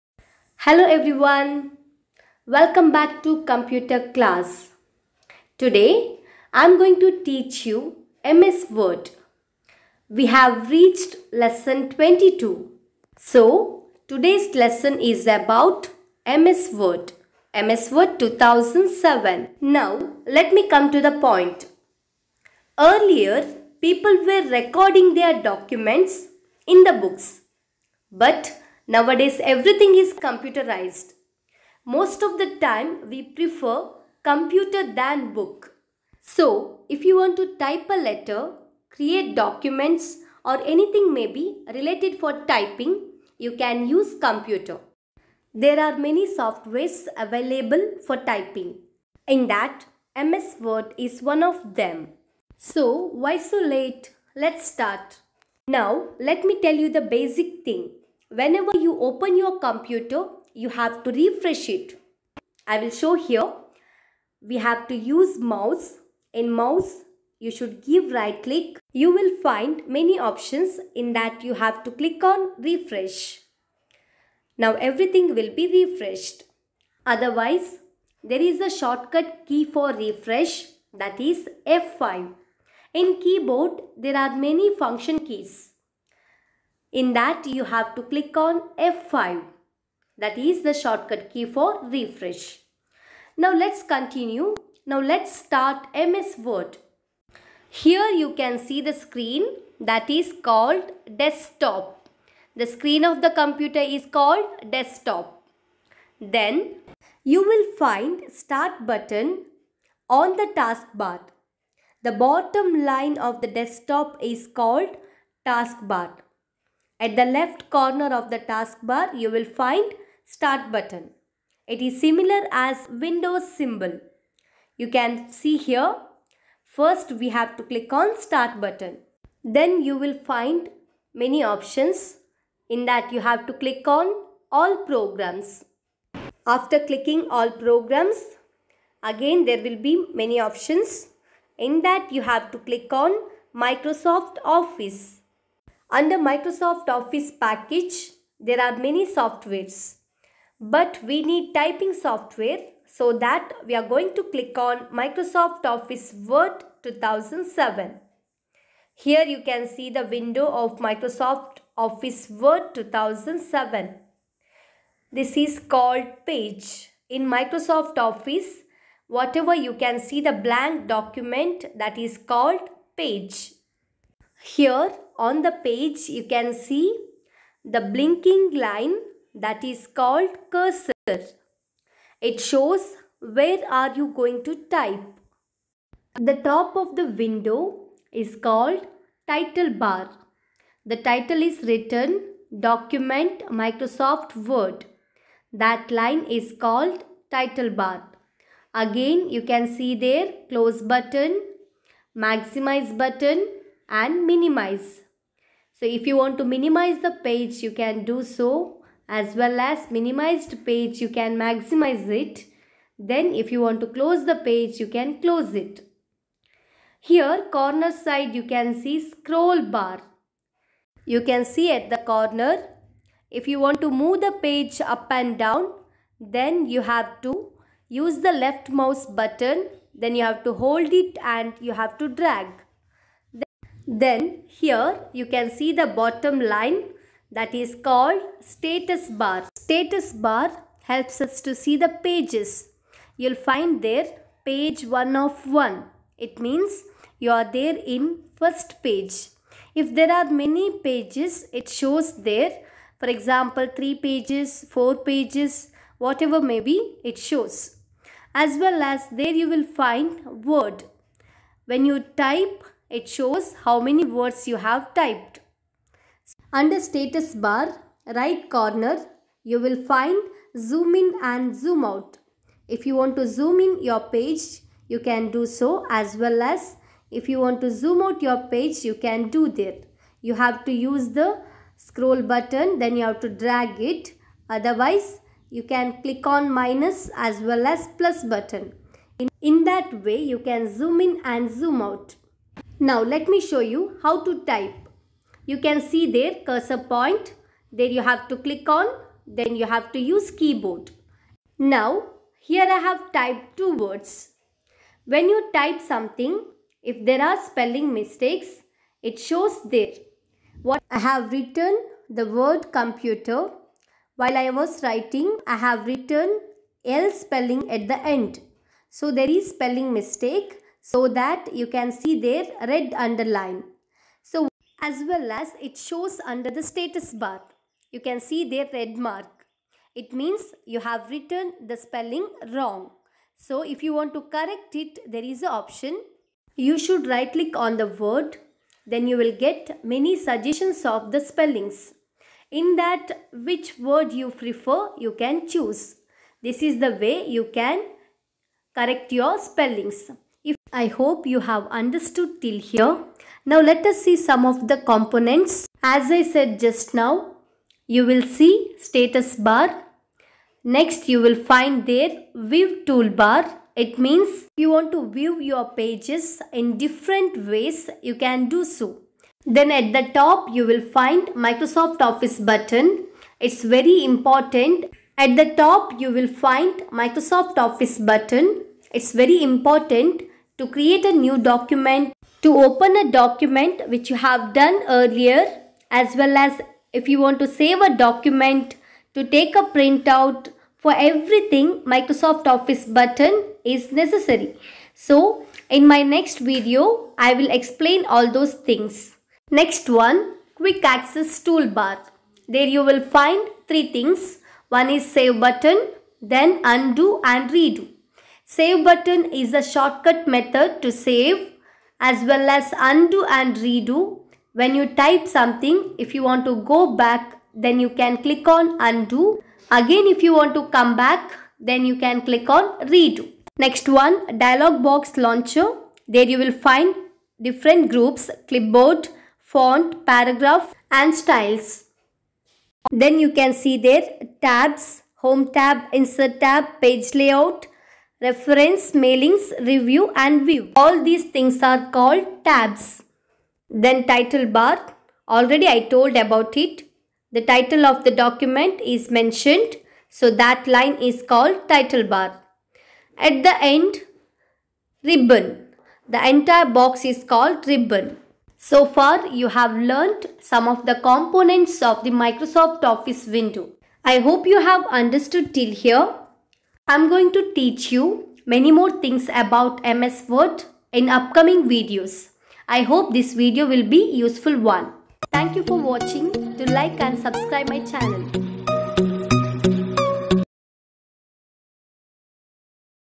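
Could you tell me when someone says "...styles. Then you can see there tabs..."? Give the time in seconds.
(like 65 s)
431 s.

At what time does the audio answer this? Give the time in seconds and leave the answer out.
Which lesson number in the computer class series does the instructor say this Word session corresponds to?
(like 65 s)
11 s.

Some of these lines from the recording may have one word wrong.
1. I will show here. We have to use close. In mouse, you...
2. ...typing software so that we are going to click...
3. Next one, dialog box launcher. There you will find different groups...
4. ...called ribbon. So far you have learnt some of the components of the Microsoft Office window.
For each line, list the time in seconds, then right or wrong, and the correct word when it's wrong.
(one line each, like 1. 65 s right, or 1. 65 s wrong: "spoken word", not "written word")
1. 62 s wrong: "mouse", not "close"
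2. 151 s right
3. 423 s right
4. 457 s right.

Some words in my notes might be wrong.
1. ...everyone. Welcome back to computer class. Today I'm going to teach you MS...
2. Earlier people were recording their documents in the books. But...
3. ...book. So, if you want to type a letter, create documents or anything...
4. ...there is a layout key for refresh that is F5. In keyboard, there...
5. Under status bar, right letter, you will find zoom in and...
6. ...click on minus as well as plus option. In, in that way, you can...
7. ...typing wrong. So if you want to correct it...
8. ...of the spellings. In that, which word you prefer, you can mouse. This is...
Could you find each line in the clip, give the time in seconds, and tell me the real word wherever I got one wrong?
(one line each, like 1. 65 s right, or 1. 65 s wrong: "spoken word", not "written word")
1. 0 s right
2. 22 s right
3. 35 s right
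4. 78 s wrong: "shortcut", not "layout"
5. 266 s wrong: "corner", not "letter"
6. 286 s wrong: "button", not "option"
7. 331 s wrong: "spelling", not "typing"
8. 340 s wrong: "choose", not "mouse".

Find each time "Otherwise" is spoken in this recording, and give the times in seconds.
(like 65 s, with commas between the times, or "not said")
77 s, 284 s.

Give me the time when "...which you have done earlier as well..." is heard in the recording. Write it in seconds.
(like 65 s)
383 s.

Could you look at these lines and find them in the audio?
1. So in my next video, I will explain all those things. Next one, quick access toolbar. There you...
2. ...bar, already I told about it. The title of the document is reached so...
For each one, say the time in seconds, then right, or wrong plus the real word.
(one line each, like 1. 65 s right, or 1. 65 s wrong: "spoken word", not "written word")
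1. 394 s right
2. 444 s wrong: "mentioned", not "reached".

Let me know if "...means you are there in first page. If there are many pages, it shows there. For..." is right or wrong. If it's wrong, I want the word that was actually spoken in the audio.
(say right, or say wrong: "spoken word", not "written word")
right.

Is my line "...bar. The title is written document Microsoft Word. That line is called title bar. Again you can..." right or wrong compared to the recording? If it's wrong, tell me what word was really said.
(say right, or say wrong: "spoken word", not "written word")
right.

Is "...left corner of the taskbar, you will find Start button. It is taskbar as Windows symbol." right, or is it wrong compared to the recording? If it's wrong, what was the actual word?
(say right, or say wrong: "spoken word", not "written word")
wrong: "similar", not "taskbar".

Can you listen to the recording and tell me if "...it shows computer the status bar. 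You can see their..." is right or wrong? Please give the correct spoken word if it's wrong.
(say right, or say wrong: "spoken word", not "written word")
wrong: "under", not "computer".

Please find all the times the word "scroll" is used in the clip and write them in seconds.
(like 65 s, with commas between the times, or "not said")
219 s, 281 s.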